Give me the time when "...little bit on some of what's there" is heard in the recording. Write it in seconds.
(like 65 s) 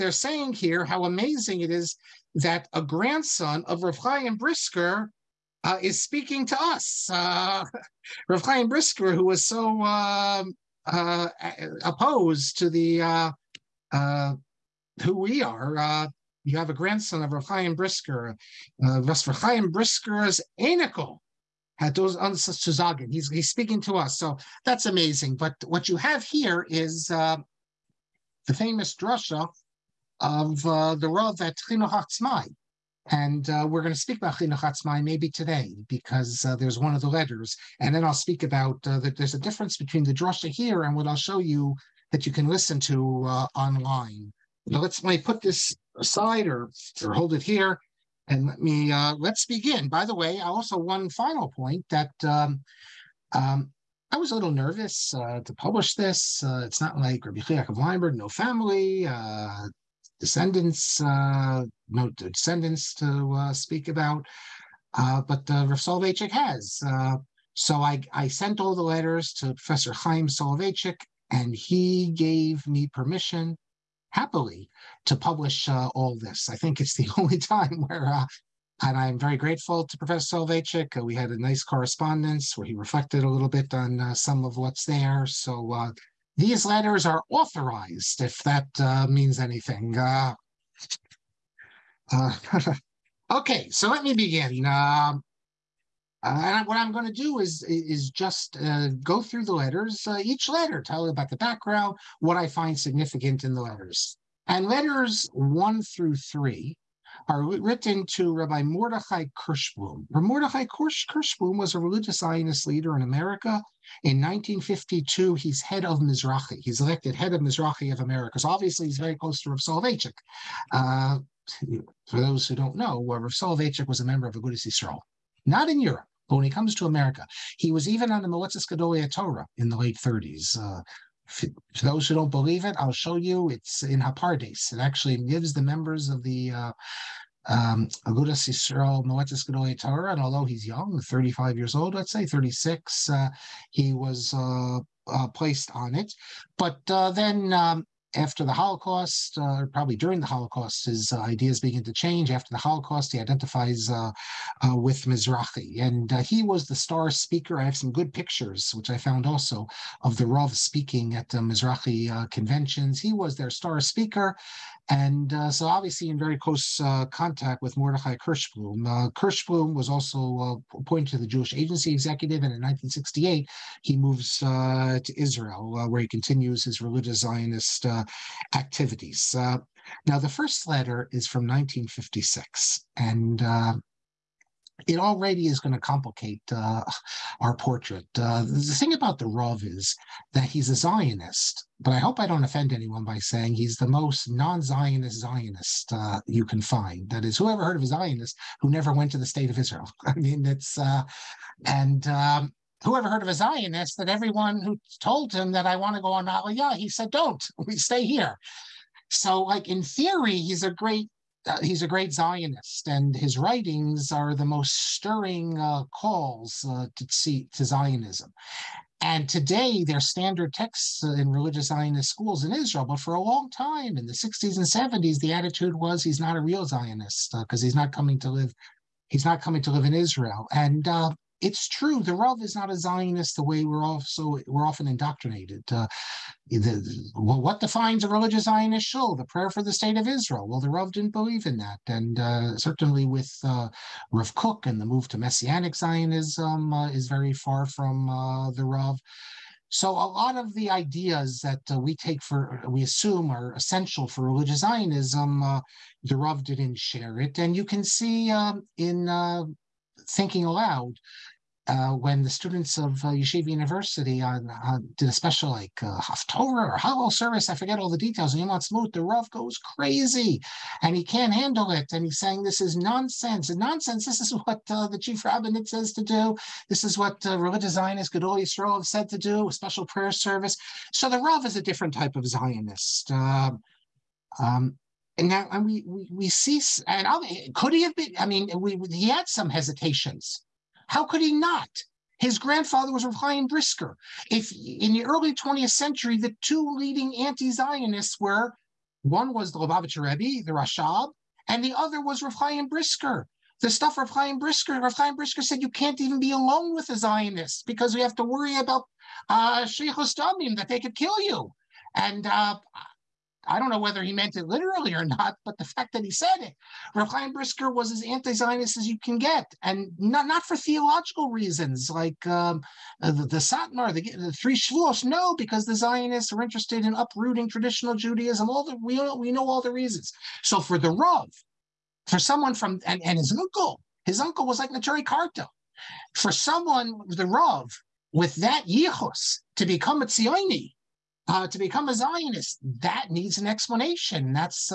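83 s.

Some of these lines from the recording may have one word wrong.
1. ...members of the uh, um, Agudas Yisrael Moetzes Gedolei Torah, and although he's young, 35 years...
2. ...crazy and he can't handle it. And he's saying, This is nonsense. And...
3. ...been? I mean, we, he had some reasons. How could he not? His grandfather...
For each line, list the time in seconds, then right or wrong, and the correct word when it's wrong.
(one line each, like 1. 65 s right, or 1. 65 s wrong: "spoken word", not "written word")
1. 135 s right
2. 269 s right
3. 287 s wrong: "hesitations", not "reasons".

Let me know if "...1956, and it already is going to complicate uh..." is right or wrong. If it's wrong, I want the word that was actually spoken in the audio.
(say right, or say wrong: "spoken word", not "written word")
right.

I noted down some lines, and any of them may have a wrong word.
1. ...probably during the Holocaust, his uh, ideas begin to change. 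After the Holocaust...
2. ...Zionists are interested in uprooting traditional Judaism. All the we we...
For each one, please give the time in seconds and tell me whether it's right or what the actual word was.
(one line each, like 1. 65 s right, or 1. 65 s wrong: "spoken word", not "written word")
1. 149 s right
2. 325 s right.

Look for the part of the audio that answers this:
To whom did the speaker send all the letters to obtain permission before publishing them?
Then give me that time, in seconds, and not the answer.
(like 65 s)
69 s.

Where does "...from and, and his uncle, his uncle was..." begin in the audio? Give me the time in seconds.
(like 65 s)
332 s.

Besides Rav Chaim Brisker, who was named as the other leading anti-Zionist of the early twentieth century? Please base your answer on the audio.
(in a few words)
the Rashab.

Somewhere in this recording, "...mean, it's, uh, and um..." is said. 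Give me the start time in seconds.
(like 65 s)
200 s.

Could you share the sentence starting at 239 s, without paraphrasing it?
The prayer for the state of Israel.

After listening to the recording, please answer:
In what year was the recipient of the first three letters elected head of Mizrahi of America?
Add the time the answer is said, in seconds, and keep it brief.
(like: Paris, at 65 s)
1952, at 114 s.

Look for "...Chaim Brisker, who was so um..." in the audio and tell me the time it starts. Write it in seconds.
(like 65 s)
8 s.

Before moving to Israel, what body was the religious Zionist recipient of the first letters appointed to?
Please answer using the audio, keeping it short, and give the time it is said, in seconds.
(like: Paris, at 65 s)
Jewish Agency Executive, at 171 s.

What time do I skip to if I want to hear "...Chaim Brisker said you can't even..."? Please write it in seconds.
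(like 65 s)
304 s.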